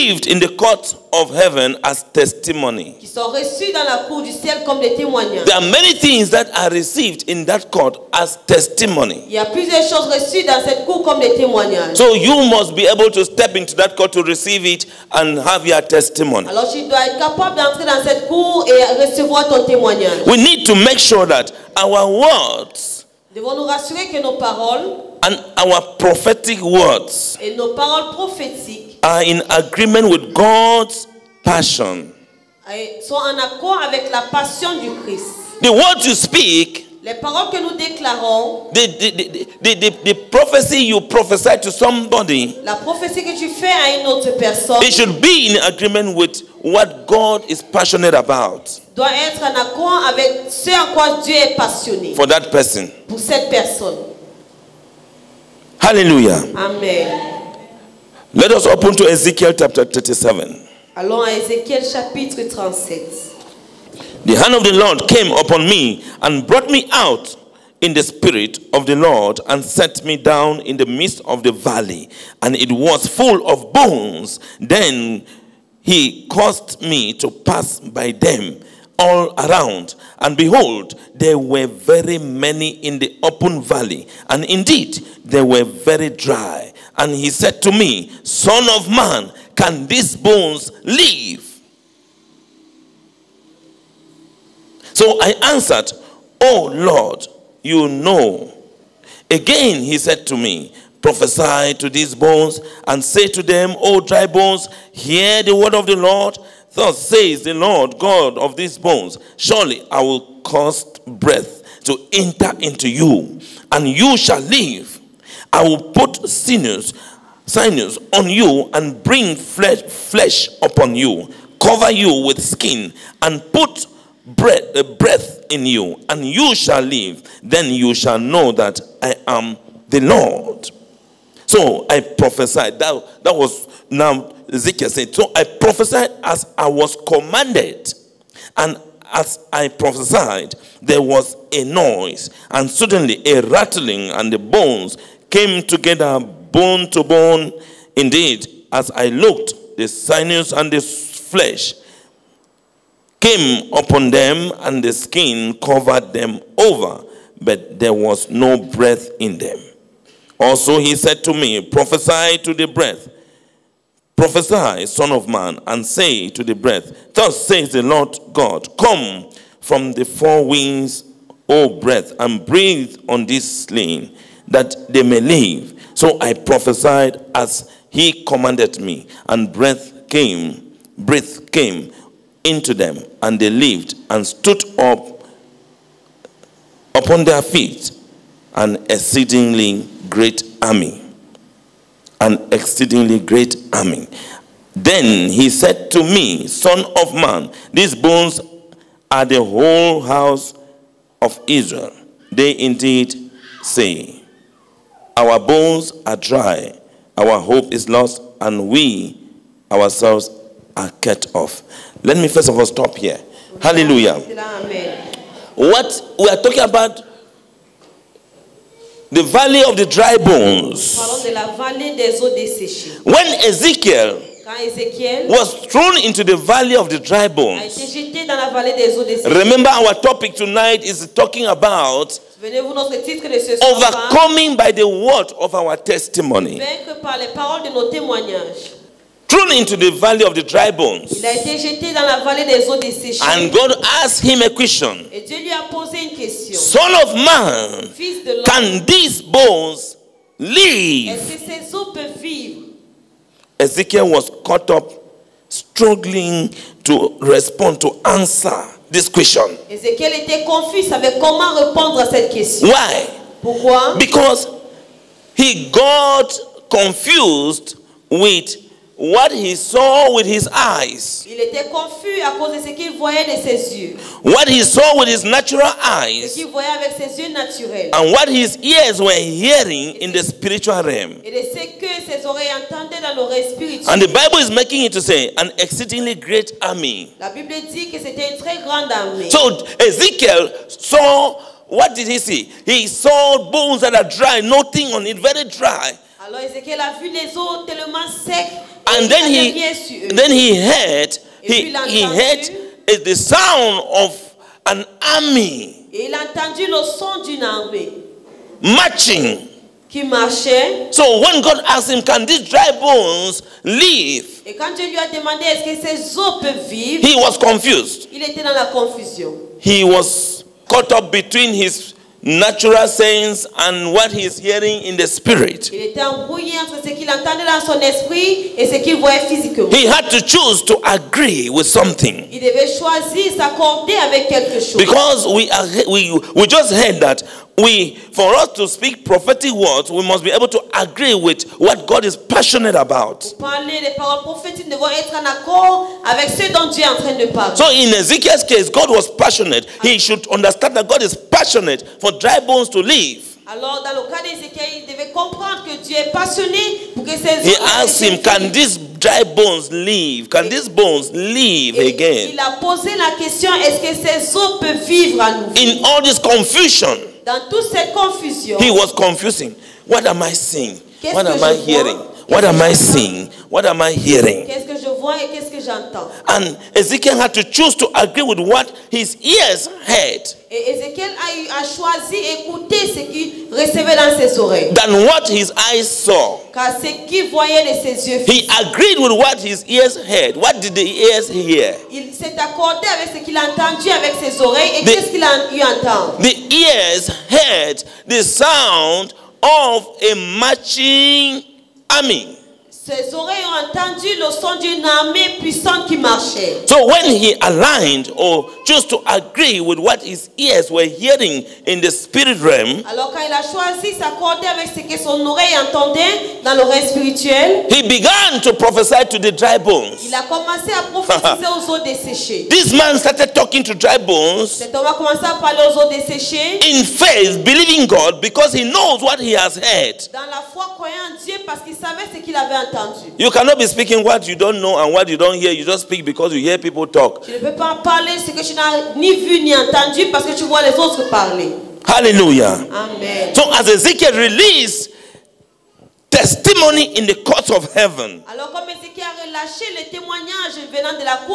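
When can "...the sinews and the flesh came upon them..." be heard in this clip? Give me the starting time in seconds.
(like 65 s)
149 s.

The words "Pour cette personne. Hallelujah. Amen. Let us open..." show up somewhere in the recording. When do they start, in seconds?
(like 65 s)
53 s.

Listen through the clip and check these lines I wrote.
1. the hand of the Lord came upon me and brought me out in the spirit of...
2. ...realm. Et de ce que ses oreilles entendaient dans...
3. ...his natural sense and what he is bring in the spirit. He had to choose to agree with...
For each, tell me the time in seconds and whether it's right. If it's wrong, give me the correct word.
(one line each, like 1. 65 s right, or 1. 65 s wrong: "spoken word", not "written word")
1. 64 s right
2. 280 s right
3. 321 s wrong: "hearing", not "bring".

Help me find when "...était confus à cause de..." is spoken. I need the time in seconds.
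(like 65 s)
271 s.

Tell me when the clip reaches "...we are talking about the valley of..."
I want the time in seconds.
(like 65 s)
216 s.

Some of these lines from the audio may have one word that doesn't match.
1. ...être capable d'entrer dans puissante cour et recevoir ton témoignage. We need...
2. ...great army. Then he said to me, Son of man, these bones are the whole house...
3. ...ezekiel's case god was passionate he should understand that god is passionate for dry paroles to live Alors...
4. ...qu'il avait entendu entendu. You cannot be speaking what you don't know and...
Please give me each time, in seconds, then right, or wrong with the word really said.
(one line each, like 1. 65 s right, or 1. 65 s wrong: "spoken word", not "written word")
1. 17 s wrong: "cette", not "puissante"
2. 193 s right
3. 347 s wrong: "bones", not "paroles"
4. 432 s right.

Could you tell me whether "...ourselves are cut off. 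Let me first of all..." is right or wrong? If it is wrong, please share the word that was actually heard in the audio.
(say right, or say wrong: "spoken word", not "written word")
right.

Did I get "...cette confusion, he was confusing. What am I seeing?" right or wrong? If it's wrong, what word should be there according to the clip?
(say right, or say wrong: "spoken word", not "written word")
right.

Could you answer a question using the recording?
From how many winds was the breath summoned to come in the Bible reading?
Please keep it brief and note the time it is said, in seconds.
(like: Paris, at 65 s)
4, at 170 s.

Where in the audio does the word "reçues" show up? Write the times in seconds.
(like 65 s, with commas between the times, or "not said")
3 s, 10 s.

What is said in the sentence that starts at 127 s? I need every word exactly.
Then you shall know that I am the Lord.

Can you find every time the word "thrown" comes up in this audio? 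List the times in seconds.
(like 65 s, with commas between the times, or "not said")
225 s, 239 s.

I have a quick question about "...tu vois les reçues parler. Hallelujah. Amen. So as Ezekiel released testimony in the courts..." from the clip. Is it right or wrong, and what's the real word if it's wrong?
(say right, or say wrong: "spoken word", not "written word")
wrong: "autres", not "reçues".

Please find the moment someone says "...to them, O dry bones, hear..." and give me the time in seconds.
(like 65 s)
103 s.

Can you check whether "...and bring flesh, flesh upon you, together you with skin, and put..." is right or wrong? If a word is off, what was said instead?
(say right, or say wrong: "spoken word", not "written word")
wrong: "cover", not "together".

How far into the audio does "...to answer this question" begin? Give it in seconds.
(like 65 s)
257 s.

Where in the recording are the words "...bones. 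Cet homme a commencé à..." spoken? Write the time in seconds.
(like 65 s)
423 s.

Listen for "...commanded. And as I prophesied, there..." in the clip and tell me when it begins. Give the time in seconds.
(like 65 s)
137 s.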